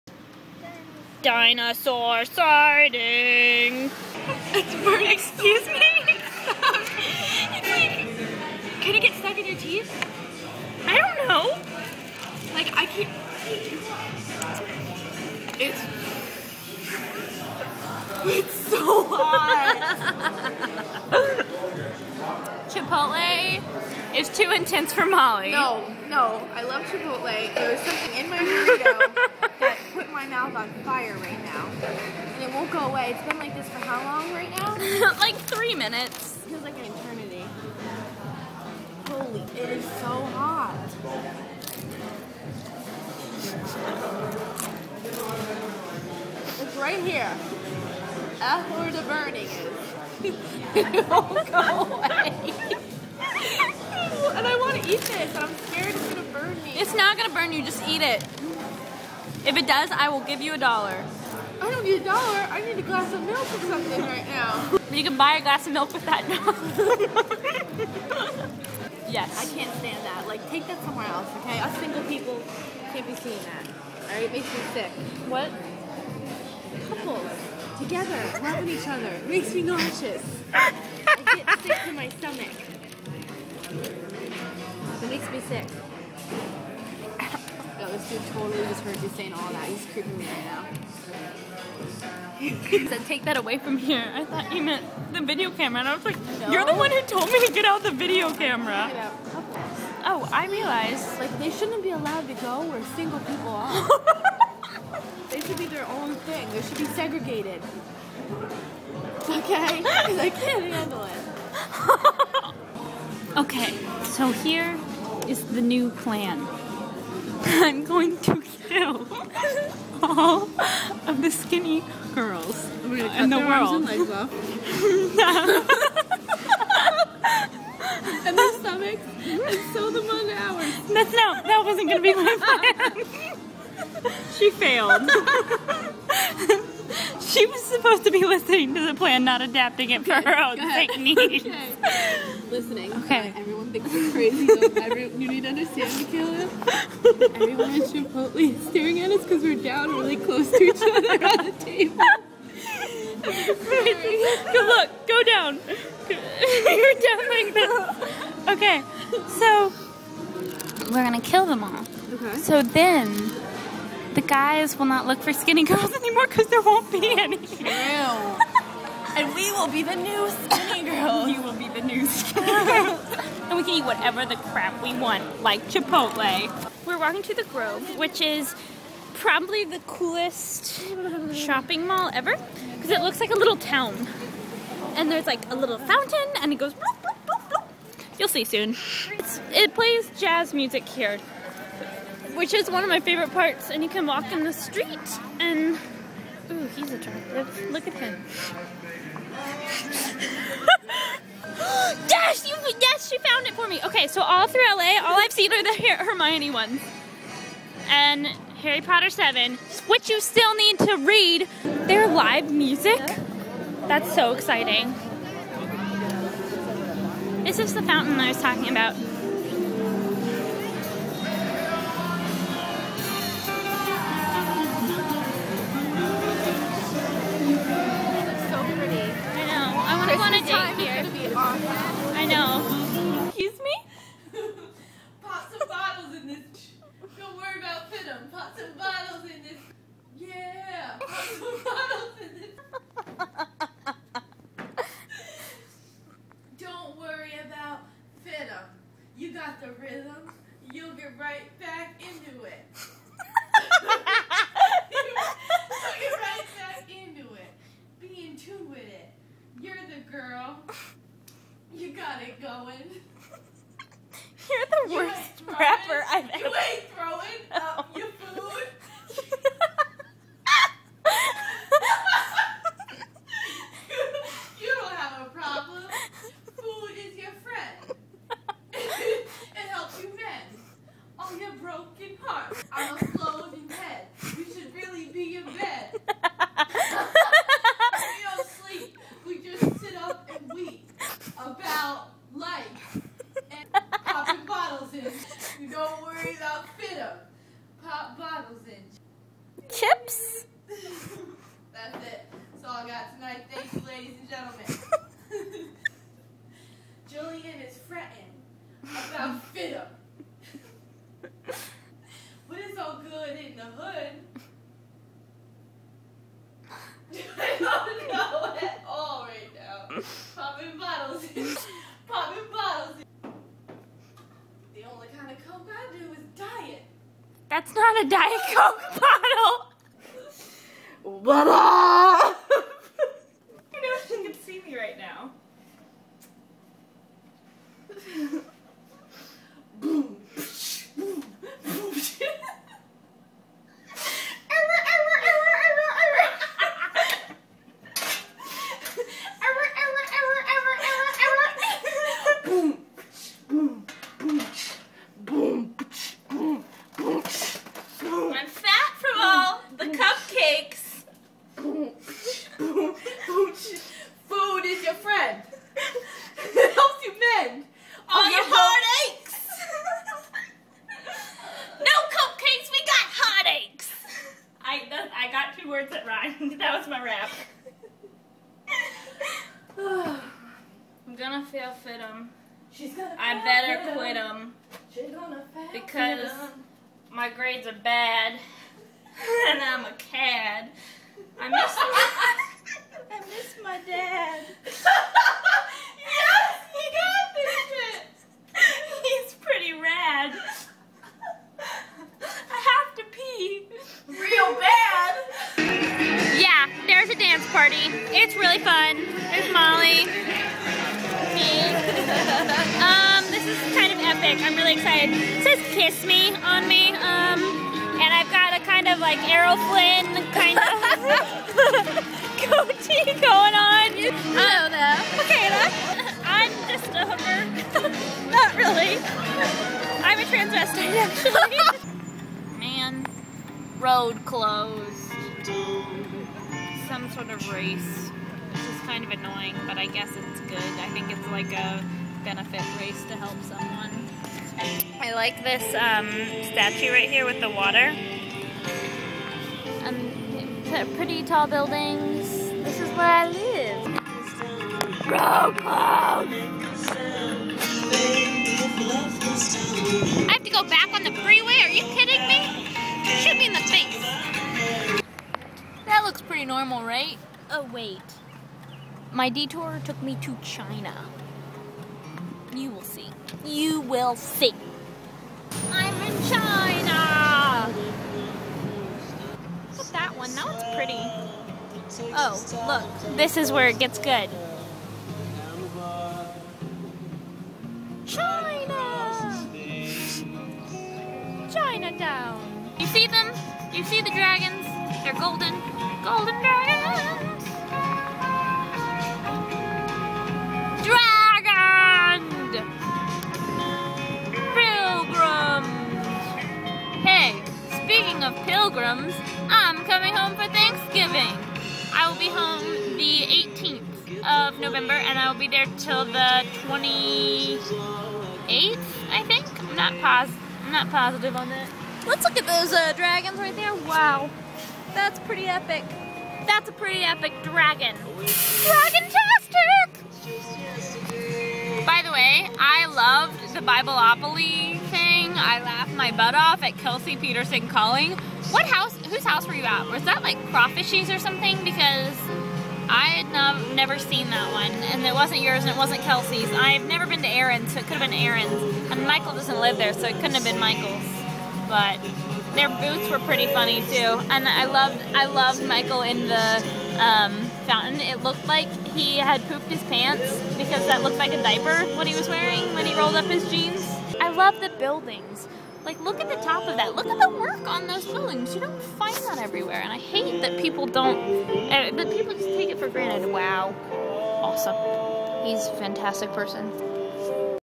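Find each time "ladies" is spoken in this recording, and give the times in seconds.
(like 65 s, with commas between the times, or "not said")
303 s.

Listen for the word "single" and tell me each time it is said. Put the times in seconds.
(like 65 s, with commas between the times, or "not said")
71 s, 102 s.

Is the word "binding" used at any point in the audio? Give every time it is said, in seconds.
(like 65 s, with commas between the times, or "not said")
not said.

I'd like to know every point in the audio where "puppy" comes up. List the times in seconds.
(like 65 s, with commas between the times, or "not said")
not said.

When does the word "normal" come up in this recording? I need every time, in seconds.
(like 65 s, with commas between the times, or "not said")
466 s.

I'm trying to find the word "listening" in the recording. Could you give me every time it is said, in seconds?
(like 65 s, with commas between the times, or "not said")
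138 s, 142 s.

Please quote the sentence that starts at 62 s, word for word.
I need a glass of milk or something right now.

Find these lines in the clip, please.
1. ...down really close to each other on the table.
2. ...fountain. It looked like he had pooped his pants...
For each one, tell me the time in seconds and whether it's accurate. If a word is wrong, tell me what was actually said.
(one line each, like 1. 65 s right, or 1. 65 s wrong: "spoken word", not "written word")
1. 149 s right
2. 557 s right.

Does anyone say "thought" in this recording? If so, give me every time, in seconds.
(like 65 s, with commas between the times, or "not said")
94 s.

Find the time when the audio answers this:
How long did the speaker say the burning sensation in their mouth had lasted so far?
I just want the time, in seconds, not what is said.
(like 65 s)
35 s.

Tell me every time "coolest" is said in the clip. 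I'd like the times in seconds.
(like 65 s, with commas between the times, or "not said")
179 s.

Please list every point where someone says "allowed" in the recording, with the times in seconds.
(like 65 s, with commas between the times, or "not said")
101 s.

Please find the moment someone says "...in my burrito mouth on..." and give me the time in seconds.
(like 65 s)
28 s.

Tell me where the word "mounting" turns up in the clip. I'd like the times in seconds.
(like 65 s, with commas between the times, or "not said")
not said.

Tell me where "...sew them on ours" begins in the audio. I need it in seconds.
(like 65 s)
129 s.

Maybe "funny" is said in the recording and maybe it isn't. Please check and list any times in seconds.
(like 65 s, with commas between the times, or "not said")
553 s.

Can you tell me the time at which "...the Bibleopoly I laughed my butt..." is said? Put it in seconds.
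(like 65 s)
533 s.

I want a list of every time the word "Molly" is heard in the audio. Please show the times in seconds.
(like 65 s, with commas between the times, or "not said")
25 s.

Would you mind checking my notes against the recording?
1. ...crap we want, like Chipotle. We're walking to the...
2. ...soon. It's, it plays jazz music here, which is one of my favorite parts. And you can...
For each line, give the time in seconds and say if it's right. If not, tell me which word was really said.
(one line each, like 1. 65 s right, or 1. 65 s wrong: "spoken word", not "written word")
1. 174 s right
2. 188 s right.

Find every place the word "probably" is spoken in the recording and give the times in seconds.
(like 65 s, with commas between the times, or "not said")
179 s.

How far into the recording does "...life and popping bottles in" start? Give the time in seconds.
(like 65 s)
292 s.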